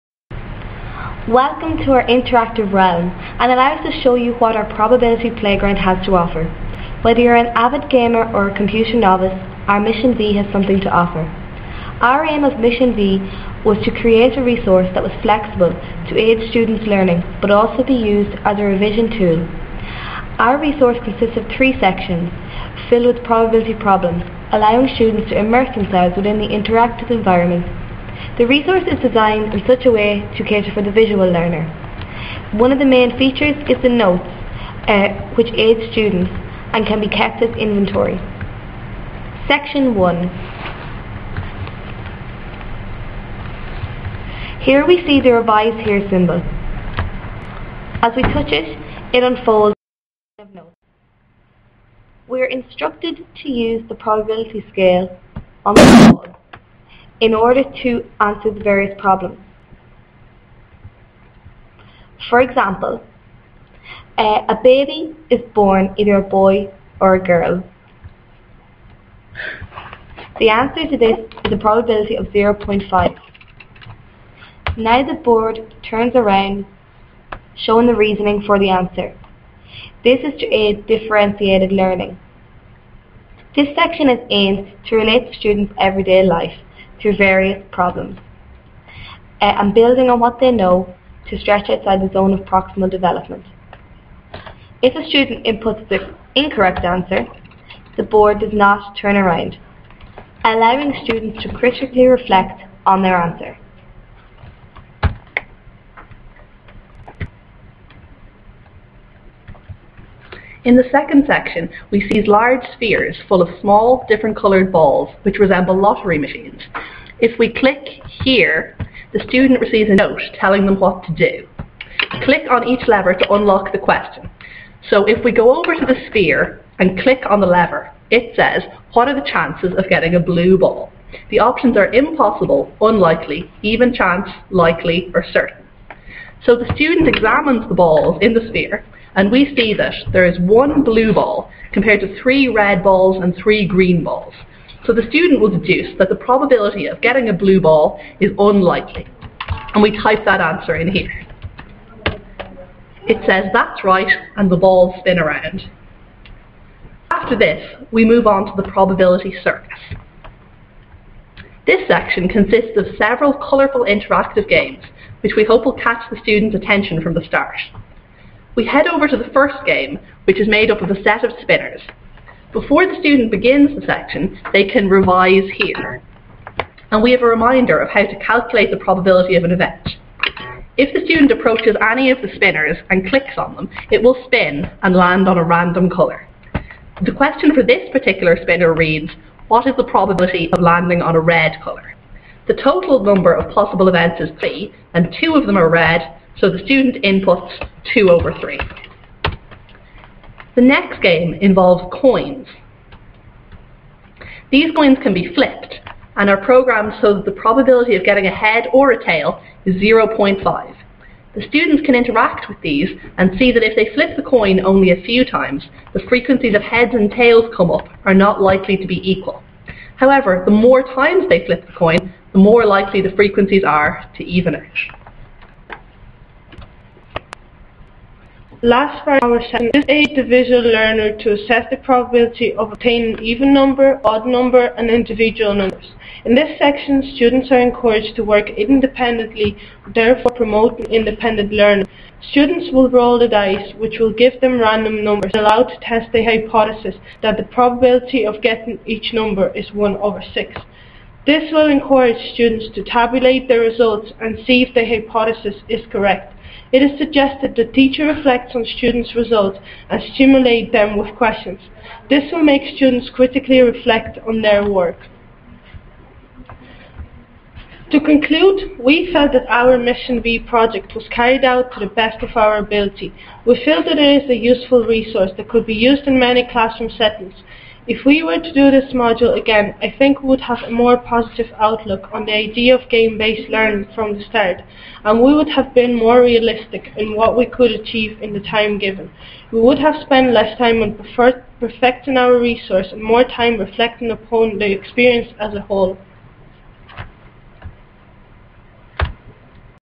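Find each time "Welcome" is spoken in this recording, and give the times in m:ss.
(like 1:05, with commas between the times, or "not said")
0:01.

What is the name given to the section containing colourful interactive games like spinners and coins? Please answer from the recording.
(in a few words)
probability circus.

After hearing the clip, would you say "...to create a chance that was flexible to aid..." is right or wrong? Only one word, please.
wrong.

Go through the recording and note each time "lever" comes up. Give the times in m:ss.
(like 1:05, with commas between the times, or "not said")
2:02, 2:07.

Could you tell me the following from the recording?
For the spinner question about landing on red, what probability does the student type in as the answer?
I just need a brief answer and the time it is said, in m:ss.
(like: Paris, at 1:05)
2/3, at 3:17.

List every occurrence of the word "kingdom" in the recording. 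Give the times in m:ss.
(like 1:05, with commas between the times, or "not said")
not said.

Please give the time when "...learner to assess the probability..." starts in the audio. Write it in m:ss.
3:50.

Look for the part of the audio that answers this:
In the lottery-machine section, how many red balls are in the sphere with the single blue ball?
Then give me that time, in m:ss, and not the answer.
2:22.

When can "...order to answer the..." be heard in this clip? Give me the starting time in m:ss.
0:57.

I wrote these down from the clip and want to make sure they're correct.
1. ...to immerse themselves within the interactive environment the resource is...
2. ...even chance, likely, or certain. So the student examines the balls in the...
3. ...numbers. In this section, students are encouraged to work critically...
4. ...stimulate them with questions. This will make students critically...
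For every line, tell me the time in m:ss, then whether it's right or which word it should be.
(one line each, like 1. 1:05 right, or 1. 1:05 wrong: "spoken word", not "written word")
1. 0:25 right
2. 2:13 right
3. 3:55 wrong: "independently", not "critically"
4. 4:20 right.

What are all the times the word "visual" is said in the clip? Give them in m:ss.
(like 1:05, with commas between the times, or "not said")
0:30, 3:50.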